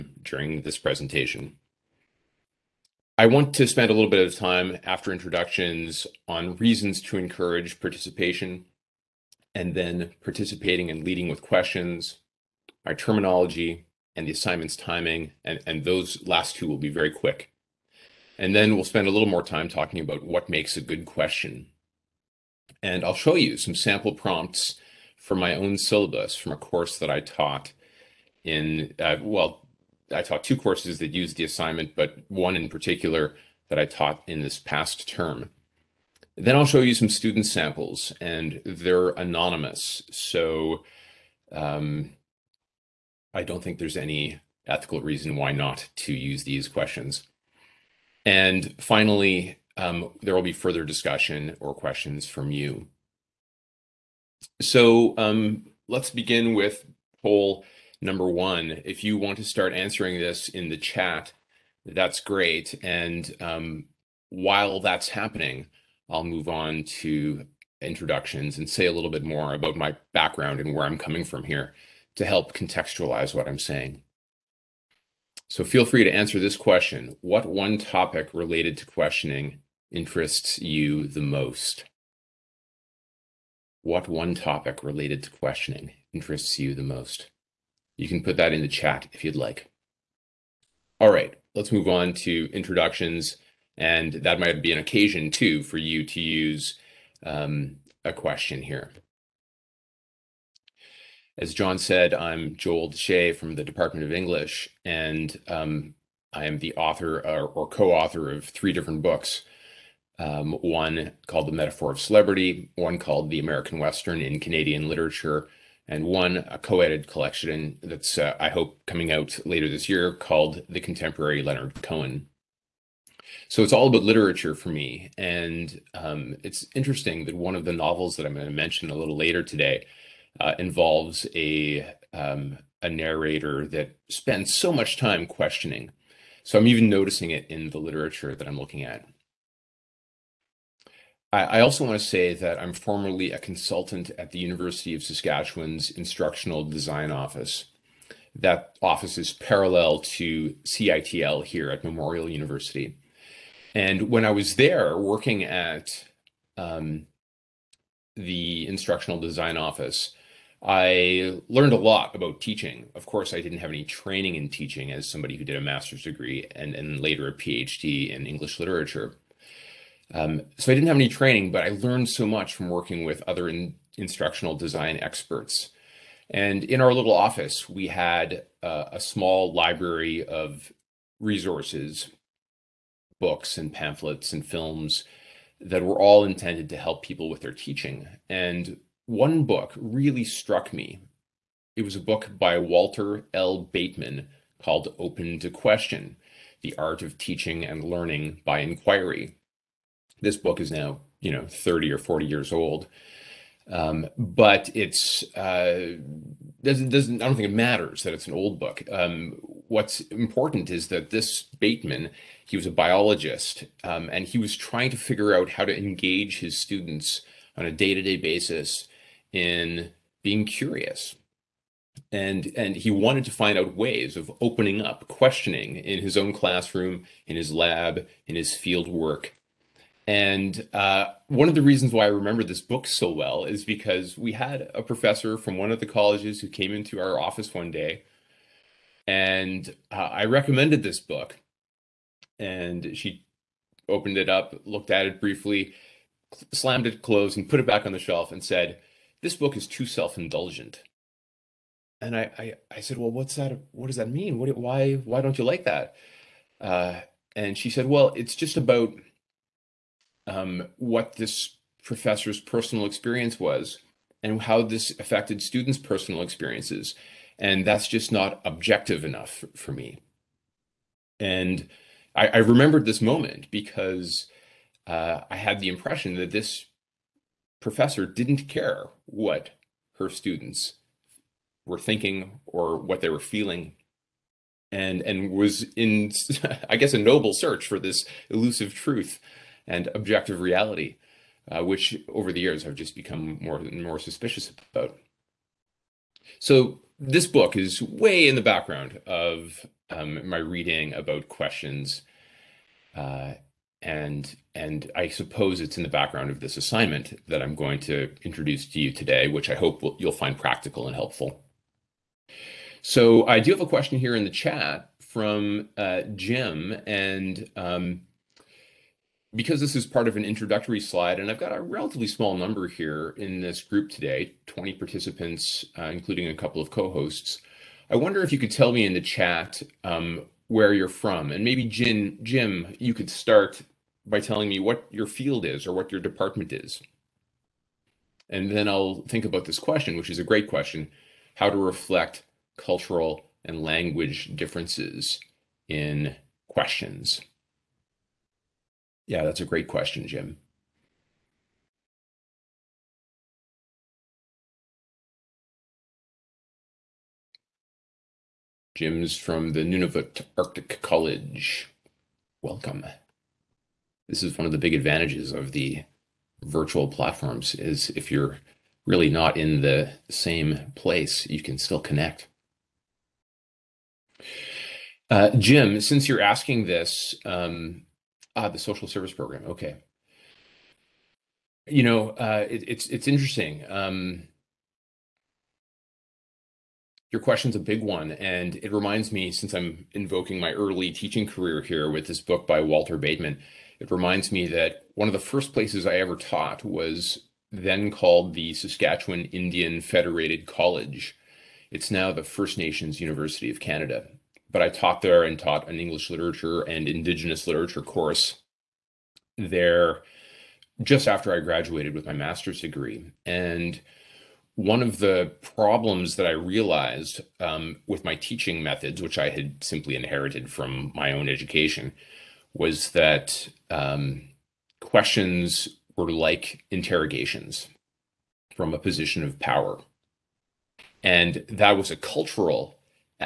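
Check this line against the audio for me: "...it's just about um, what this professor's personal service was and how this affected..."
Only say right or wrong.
wrong.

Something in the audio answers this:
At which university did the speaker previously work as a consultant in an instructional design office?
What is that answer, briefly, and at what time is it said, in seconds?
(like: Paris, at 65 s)
University of Saskatchewan, at 144 s.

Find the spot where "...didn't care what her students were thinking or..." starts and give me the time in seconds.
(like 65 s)
278 s.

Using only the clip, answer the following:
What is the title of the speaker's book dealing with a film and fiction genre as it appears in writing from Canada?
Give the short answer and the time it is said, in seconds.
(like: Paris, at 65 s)
The American Western in Canadian Literature, at 113 s.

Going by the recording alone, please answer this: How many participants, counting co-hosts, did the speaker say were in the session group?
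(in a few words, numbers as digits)
20.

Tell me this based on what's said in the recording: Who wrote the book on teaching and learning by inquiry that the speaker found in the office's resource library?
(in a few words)
Walter L. Bateman.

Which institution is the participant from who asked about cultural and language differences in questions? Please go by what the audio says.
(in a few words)
Nunavut Arctic College.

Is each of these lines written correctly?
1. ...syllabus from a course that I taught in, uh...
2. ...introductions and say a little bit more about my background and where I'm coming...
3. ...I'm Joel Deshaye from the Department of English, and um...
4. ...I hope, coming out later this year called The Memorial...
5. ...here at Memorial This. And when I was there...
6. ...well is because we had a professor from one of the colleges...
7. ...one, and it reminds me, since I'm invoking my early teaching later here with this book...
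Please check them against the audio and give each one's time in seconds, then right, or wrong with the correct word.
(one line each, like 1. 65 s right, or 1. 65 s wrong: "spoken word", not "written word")
1. 25 s right
2. 67 s right
3. 102 s right
4. 118 s wrong: "Contemporary", not "Memorial"
5. 151 s wrong: "University", not "This"
6. 233 s right
7. 387 s wrong: "career", not "later".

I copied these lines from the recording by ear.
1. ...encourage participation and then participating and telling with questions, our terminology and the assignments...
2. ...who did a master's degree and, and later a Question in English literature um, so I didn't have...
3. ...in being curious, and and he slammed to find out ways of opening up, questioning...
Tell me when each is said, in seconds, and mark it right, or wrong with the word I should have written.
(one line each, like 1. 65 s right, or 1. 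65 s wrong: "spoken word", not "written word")
1. 7 s wrong: "leading", not "telling"
2. 165 s wrong: "PhD", not "Question"
3. 219 s wrong: "wanted", not "slammed".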